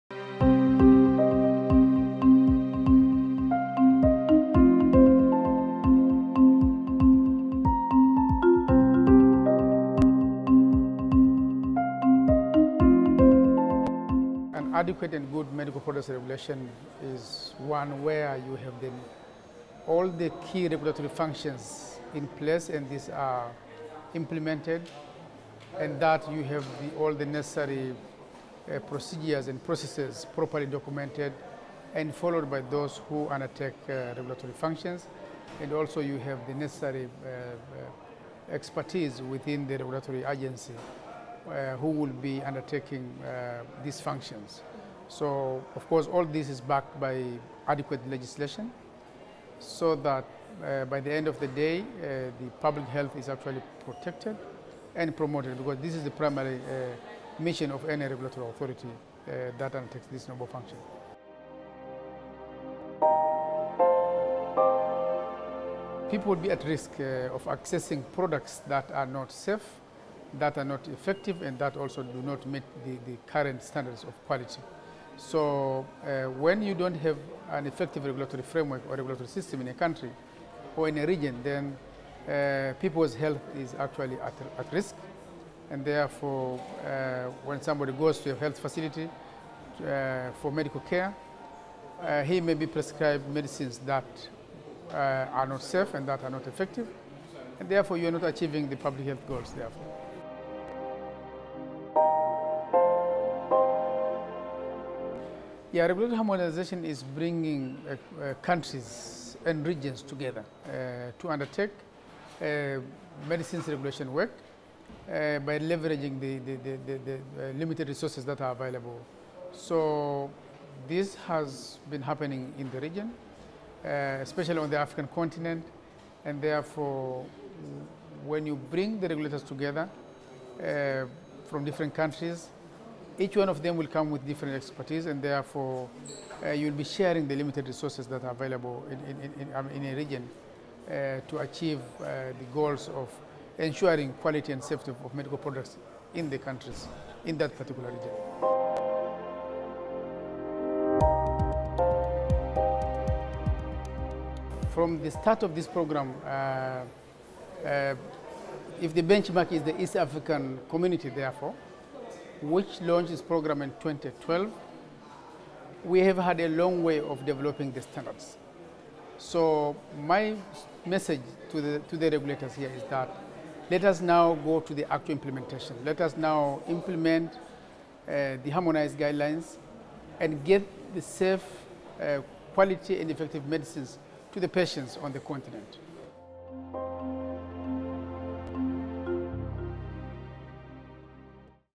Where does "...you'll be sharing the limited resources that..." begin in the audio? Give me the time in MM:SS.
02:16.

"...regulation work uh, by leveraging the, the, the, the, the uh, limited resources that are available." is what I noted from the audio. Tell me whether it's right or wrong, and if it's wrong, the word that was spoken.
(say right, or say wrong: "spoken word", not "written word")
right.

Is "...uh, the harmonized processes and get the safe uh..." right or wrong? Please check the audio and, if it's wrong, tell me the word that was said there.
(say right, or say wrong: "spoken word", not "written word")
wrong: "guidelines", not "processes".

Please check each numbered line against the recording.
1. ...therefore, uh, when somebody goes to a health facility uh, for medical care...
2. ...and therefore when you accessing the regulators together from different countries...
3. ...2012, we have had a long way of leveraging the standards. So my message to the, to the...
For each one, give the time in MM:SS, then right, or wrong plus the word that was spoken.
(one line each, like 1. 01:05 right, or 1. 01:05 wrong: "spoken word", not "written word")
1. 01:25 right
2. 02:06 wrong: "bring", not "accessing"
3. 02:43 wrong: "developing", not "leveraging".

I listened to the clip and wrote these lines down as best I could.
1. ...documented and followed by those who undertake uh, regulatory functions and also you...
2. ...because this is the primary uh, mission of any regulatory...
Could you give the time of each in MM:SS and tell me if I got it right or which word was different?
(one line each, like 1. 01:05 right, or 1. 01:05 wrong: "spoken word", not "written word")
1. 00:30 right
2. 00:55 right.